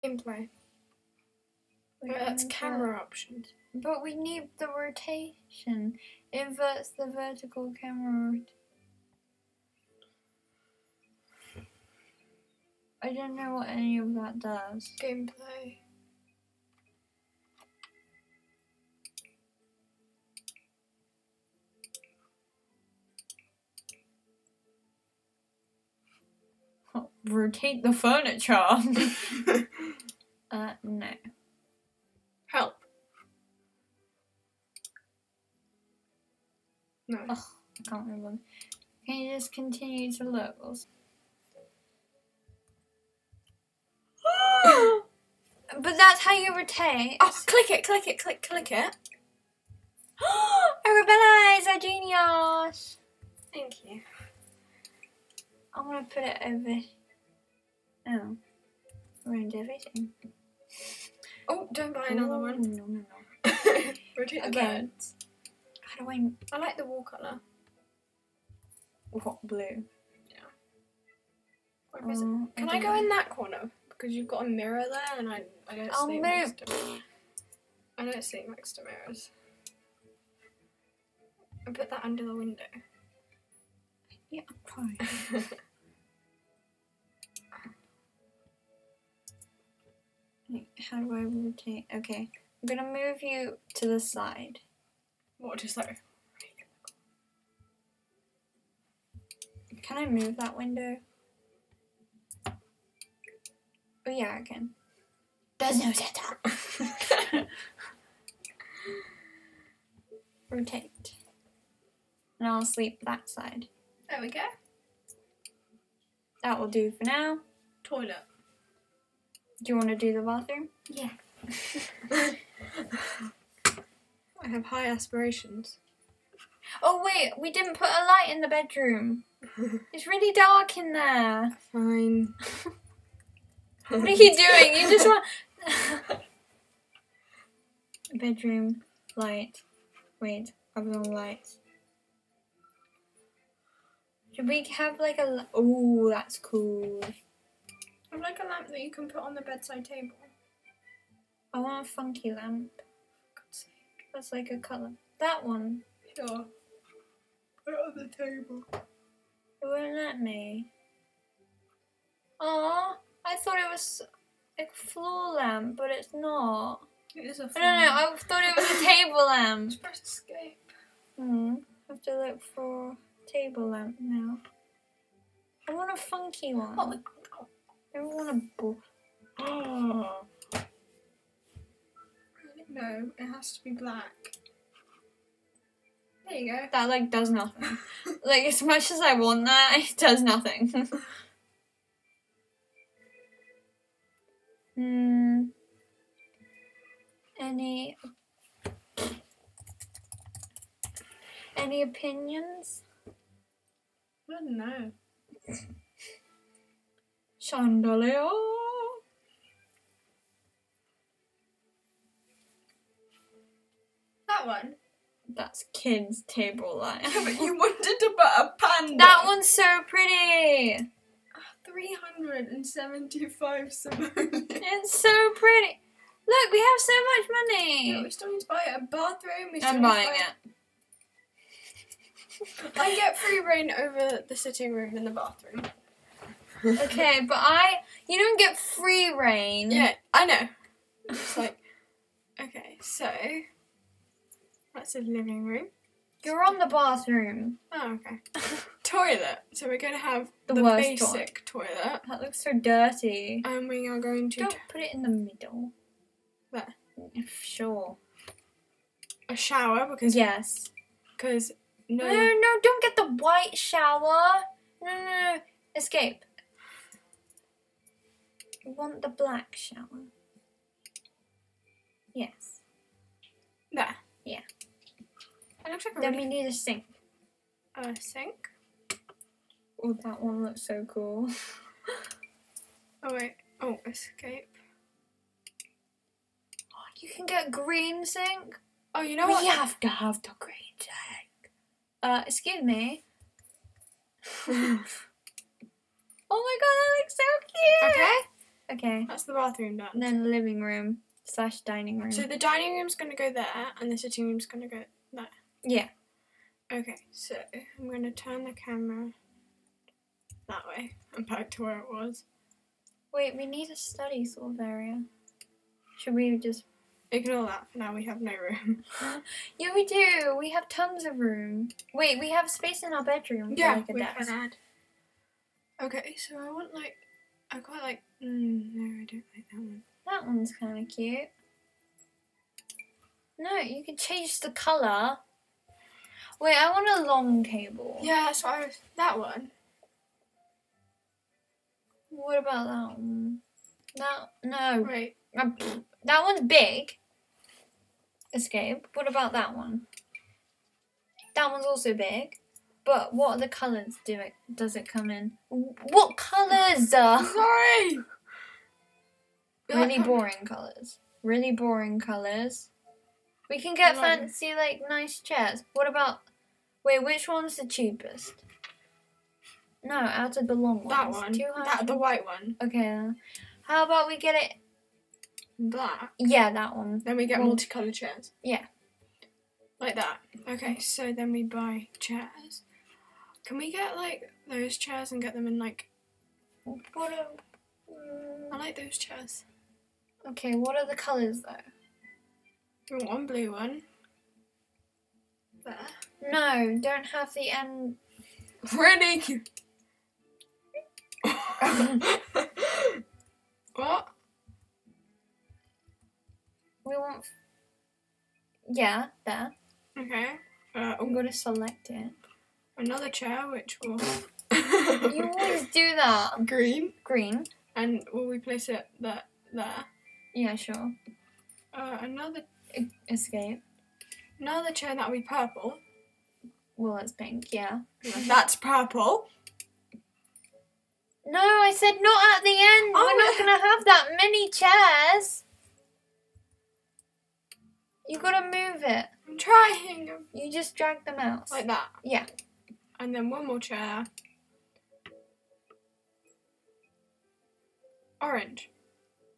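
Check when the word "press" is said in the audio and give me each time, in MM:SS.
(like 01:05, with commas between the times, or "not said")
02:49.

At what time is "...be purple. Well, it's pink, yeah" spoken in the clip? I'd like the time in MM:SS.
07:05.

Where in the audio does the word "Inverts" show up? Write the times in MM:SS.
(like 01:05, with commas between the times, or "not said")
00:06.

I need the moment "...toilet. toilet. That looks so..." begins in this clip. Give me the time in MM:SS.
04:11.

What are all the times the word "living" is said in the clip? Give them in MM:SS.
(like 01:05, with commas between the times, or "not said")
04:05, 05:00.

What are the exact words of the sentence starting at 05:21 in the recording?
Wait, we have space in our bedroom.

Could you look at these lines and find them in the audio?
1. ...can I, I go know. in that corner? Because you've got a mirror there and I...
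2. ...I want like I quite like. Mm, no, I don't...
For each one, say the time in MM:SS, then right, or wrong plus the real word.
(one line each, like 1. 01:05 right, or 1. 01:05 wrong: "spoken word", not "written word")
1. 01:12 right
2. 05:26 right.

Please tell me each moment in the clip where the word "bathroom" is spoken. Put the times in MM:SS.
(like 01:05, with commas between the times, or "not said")
02:00, 03:48, 03:55, 04:06, 04:59.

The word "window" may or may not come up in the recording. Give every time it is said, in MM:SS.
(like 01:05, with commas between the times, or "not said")
01:22, 01:40.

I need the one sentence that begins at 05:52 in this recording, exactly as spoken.
But what other colours do it does it come in?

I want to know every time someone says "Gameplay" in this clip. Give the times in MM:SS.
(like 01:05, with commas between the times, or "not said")
00:00, 00:15.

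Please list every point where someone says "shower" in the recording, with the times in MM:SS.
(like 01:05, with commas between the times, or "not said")
04:19, 04:23, 04:29.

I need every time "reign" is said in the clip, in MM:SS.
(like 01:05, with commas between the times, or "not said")
03:53, 03:59.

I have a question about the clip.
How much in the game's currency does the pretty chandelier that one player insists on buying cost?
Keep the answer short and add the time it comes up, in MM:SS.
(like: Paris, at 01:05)
375 simoleons, at 03:41.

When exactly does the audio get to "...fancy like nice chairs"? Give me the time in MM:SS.
06:03.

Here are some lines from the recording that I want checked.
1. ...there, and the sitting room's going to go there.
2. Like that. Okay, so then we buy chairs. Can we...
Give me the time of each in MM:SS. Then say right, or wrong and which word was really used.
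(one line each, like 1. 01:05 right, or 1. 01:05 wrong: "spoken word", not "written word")
1. 05:03 right
2. 06:19 right.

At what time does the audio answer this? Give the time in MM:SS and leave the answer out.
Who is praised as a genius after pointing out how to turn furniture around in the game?
00:50.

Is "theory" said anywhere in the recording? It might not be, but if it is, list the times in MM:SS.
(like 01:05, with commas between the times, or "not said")
not said.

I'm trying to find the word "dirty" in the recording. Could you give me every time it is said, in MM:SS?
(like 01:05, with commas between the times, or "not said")
04:12.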